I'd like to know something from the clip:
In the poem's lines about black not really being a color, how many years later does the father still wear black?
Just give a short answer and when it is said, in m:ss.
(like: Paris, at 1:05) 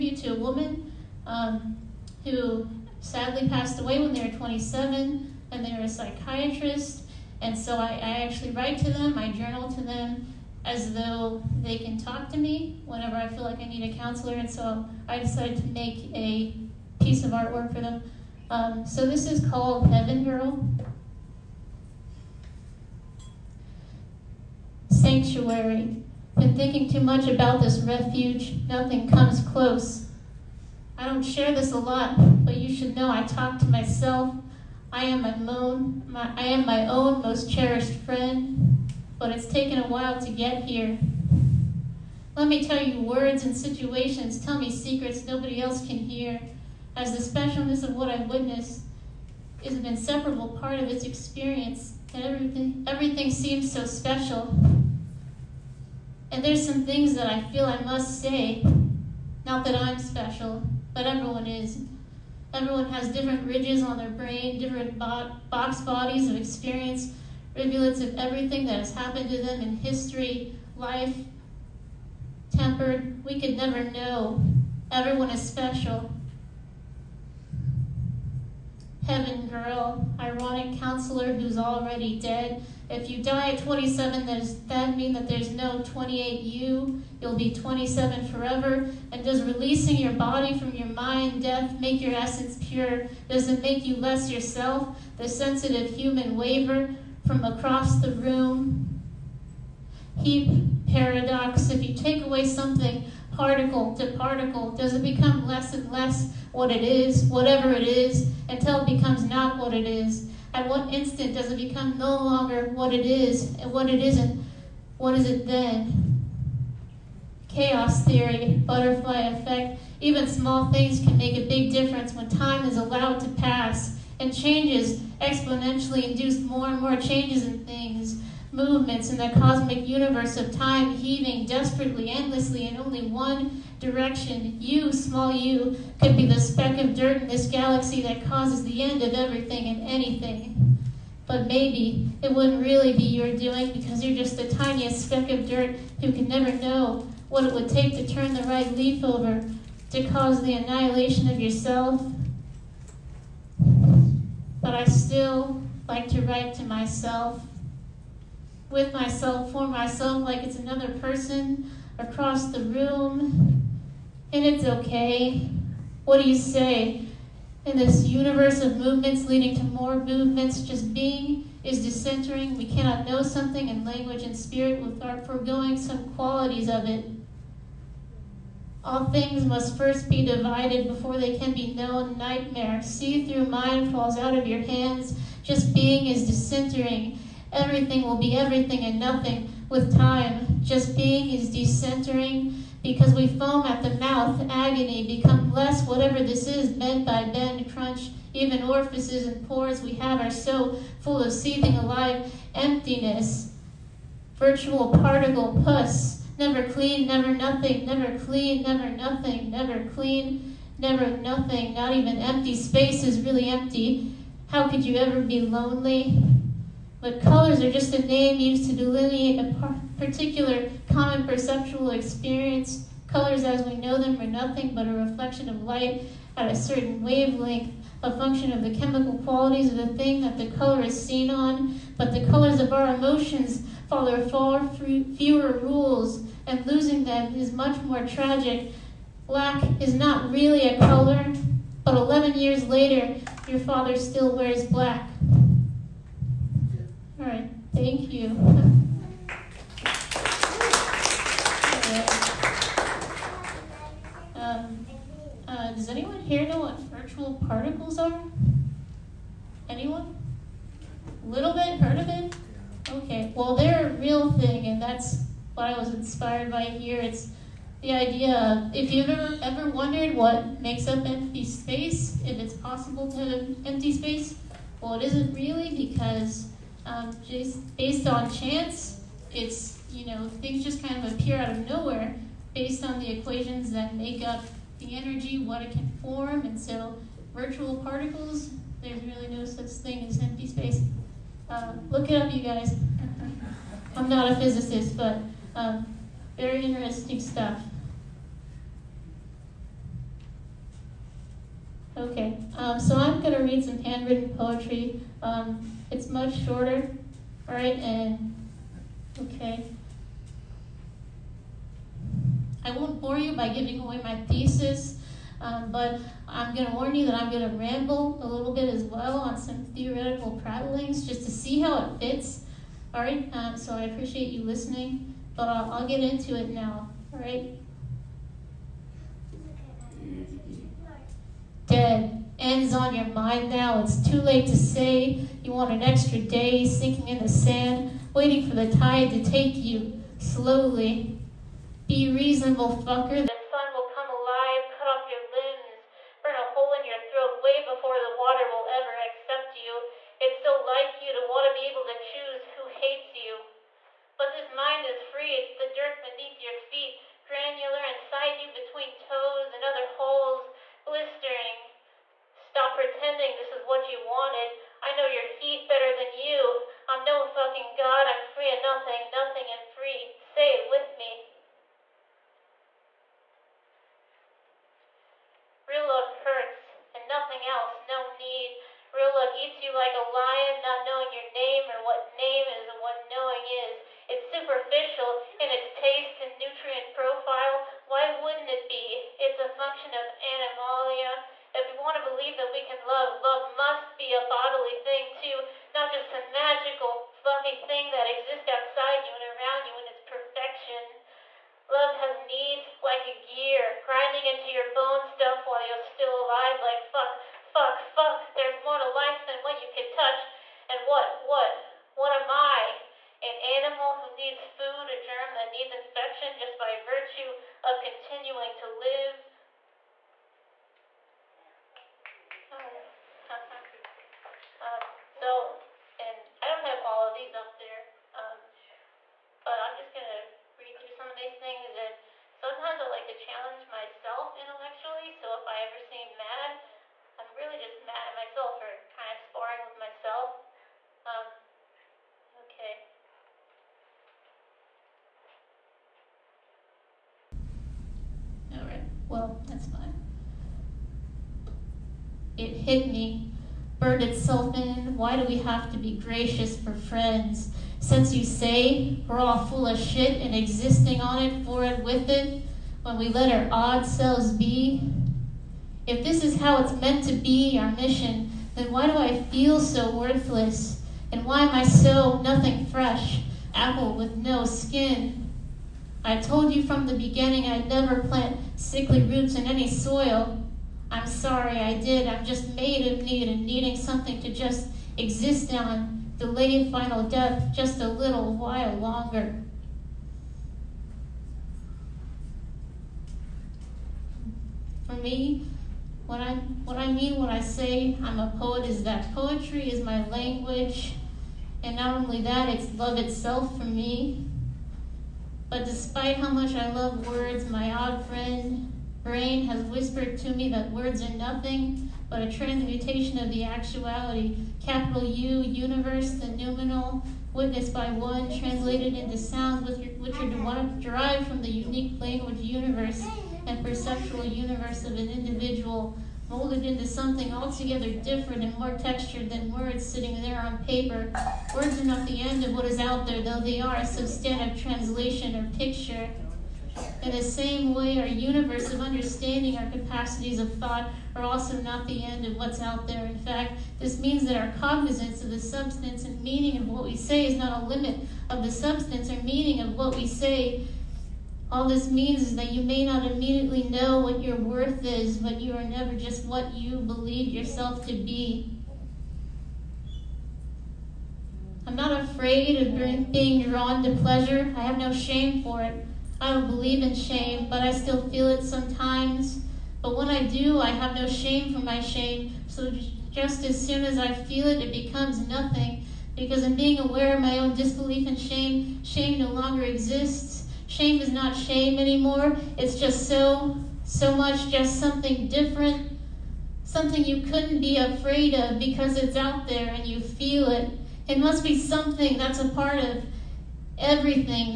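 11, at 4:01.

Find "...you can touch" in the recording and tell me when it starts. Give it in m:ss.
6:49.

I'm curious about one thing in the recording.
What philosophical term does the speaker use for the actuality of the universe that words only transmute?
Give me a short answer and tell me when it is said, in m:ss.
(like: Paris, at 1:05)
The noumenal, at 8:36.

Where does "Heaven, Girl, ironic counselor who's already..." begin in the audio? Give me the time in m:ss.
1:19.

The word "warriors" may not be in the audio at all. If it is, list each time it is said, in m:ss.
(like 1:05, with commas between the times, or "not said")
not said.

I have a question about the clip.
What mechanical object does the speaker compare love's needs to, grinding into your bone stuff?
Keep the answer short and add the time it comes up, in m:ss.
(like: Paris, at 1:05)
A gear, at 6:42.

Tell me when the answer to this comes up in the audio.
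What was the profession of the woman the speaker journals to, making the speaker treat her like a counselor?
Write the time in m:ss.
0:05.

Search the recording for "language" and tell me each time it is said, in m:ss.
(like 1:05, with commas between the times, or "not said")
2:53, 8:20, 8:41.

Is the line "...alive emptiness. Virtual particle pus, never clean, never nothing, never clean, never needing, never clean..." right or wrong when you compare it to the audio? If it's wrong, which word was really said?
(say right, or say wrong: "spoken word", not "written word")
wrong: "nothing", not "needing".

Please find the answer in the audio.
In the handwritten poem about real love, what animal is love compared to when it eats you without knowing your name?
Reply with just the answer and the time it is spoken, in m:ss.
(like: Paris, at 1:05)
A lion, at 6:19.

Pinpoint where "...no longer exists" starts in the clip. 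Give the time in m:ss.
9:39.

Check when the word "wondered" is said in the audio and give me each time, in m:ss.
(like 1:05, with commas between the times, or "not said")
4:29.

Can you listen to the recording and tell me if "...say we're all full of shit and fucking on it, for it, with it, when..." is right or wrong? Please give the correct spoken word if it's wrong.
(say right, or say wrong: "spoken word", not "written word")
wrong: "existing", not "fucking".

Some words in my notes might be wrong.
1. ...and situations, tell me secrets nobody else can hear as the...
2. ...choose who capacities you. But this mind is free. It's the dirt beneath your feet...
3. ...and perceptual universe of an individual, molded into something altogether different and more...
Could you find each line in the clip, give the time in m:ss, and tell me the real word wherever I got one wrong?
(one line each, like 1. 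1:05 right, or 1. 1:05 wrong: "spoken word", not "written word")
1. 0:43 right
2. 5:52 wrong: "hates", not "capacities"
3. 8:43 right.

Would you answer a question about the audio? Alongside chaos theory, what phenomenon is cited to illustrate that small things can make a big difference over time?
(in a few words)
Butterfly effect.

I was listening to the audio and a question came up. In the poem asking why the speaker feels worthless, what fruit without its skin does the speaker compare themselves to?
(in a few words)
Apple.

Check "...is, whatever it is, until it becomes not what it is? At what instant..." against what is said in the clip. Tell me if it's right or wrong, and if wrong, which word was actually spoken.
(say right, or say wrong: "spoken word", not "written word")
right.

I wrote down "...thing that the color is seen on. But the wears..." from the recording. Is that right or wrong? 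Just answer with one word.
wrong.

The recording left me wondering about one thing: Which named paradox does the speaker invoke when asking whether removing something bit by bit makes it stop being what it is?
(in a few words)
Heap paradox.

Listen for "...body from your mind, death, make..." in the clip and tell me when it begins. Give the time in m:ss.
1:30.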